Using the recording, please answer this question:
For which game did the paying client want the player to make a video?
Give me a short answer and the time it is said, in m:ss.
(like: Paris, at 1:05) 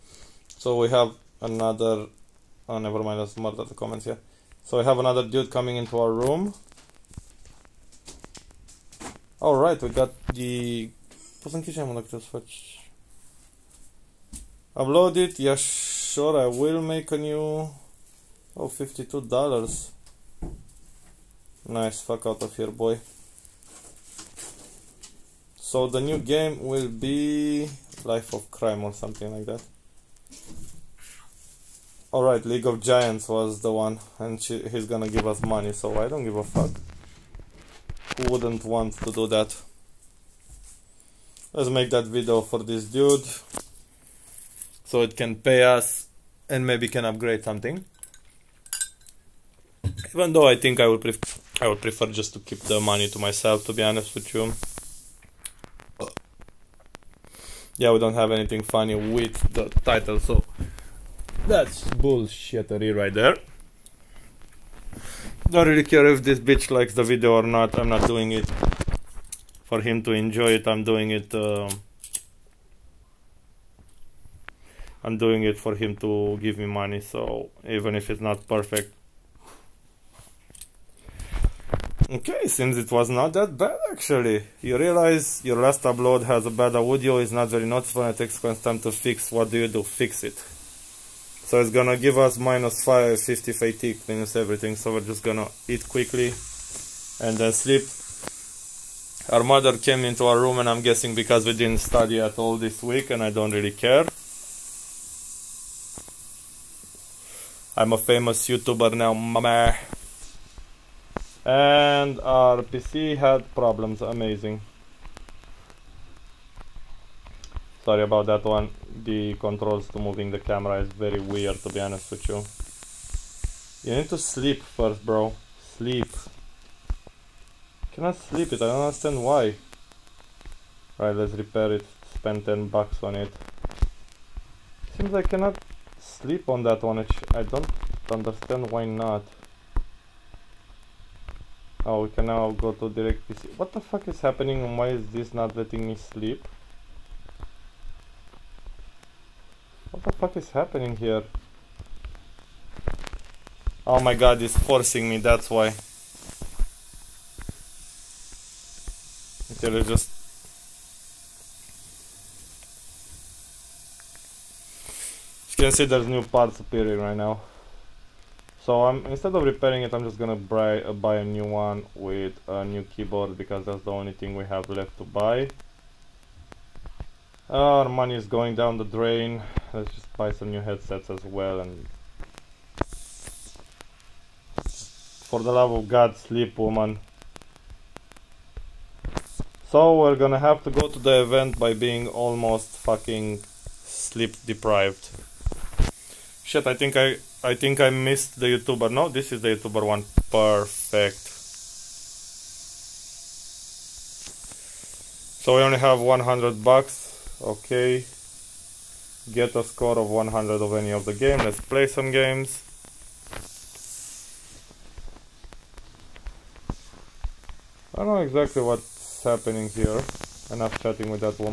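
League of Giants, at 0:32.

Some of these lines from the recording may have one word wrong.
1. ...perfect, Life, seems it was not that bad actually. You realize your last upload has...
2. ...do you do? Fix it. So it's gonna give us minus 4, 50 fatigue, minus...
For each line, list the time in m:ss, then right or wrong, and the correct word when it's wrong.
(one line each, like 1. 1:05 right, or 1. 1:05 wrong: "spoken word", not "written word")
1. 1:18 wrong: "Okay", not "Life"
2. 1:29 wrong: "5", not "4".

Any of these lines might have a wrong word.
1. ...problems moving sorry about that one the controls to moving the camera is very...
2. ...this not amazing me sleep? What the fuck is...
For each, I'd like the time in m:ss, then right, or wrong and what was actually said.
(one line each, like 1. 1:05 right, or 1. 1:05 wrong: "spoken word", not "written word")
1. 1:53 wrong: "amazing", not "moving"
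2. 2:25 wrong: "letting", not "amazing".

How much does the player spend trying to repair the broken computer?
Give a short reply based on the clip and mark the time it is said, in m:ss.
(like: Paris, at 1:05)
10 bucks, at 2:12.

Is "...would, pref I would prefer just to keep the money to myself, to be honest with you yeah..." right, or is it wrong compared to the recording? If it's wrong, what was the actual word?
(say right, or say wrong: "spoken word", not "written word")
right.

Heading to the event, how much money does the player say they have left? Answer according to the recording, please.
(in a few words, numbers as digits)
100 bucks.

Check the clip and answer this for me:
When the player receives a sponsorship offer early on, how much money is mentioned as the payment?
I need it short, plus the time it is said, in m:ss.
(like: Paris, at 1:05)
$52, at 0:18.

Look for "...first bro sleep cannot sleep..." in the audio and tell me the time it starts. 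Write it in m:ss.
2:04.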